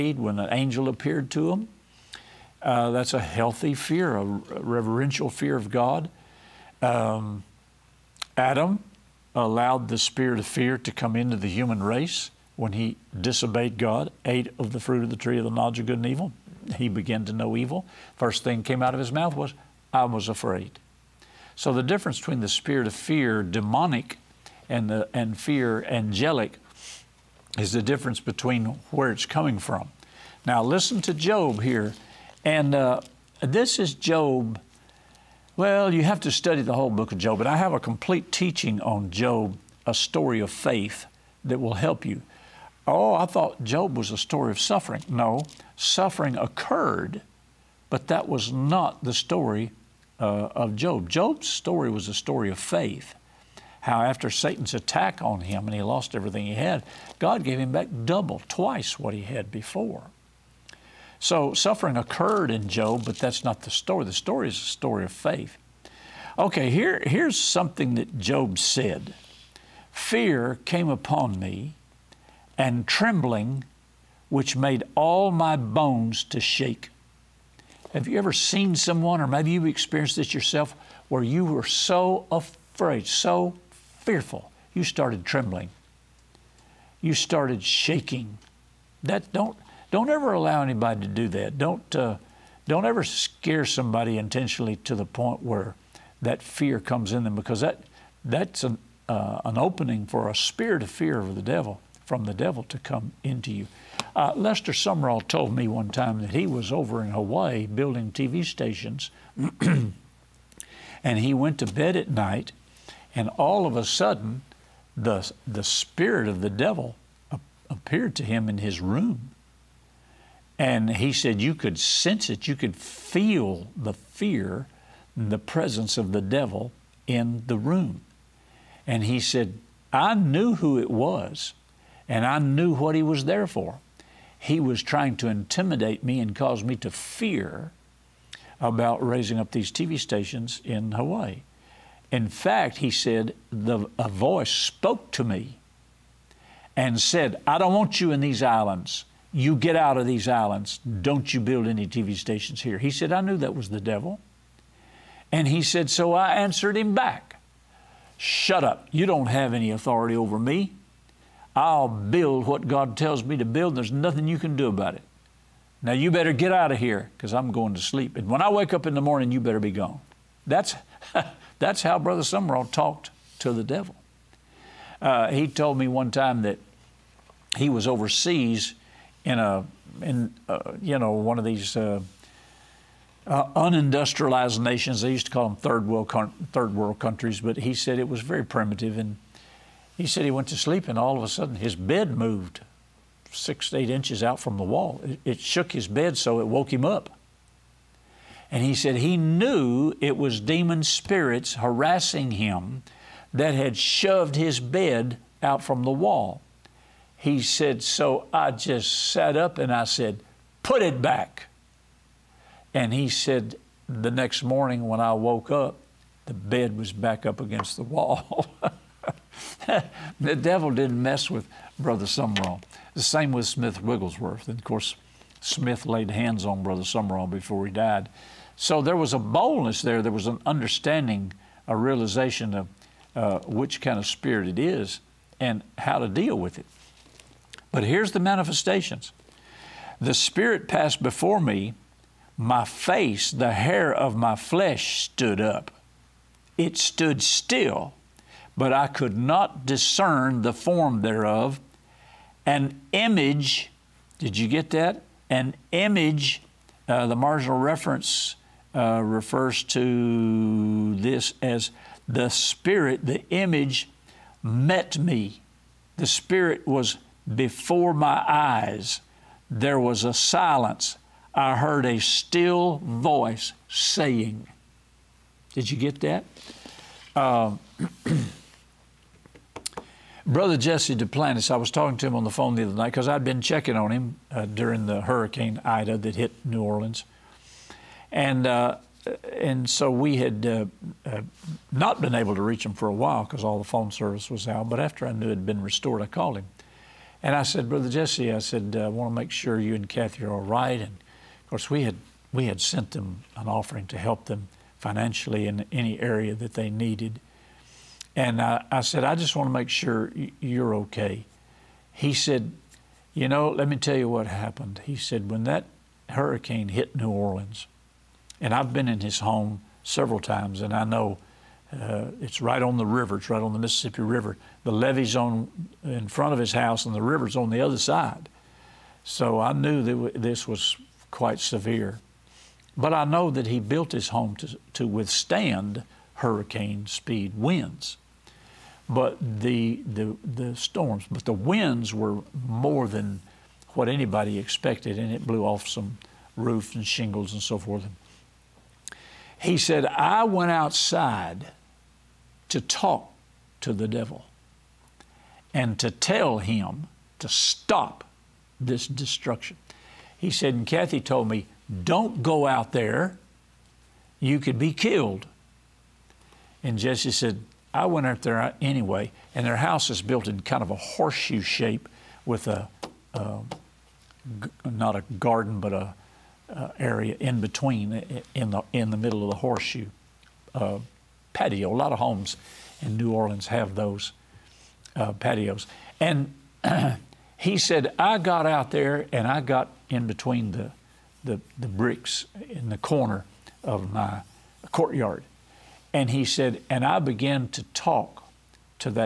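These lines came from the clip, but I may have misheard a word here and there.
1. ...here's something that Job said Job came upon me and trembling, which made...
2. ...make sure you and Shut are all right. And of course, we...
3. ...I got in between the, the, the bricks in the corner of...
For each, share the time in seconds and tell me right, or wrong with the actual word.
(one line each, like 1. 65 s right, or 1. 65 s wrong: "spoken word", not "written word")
1. 67 s wrong: "Fear", not "Job"
2. 299 s wrong: "Cathy", not "Shut"
3. 389 s right.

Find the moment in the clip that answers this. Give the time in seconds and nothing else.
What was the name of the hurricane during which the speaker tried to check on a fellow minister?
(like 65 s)
285 s.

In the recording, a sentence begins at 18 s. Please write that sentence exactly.
First thing came out of his mouth was, I was afraid.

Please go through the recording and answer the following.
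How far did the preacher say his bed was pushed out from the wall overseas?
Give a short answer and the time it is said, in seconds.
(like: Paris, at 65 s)
6 to 8 inches, at 193 s.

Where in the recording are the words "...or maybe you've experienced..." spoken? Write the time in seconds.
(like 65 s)
79 s.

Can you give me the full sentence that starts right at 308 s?
And I, I said, I just want to make sure you're okay.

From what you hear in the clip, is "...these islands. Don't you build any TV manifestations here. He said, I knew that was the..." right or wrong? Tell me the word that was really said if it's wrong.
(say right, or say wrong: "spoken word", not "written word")
wrong: "stations", not "manifestations".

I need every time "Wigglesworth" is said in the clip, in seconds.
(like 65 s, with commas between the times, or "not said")
223 s.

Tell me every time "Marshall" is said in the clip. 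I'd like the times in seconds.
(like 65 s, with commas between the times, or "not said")
not said.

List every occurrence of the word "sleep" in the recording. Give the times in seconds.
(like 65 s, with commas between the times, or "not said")
167 s, 190 s.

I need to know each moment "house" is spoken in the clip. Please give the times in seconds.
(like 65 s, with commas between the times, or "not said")
326 s, 369 s.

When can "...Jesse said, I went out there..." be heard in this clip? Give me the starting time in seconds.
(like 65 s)
366 s.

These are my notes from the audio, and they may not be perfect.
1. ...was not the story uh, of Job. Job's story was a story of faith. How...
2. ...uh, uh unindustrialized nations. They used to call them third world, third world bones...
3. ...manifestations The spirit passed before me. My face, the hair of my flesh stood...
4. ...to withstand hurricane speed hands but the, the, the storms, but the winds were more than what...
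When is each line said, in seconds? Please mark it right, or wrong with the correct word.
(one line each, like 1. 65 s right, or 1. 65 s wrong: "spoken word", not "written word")
1. 48 s right
2. 181 s wrong: "countries", not "bones"
3. 238 s right
4. 334 s wrong: "winds", not "hands".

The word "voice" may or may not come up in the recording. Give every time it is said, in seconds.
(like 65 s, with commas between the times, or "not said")
144 s, 272 s.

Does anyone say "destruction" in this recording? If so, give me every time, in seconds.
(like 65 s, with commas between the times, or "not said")
358 s.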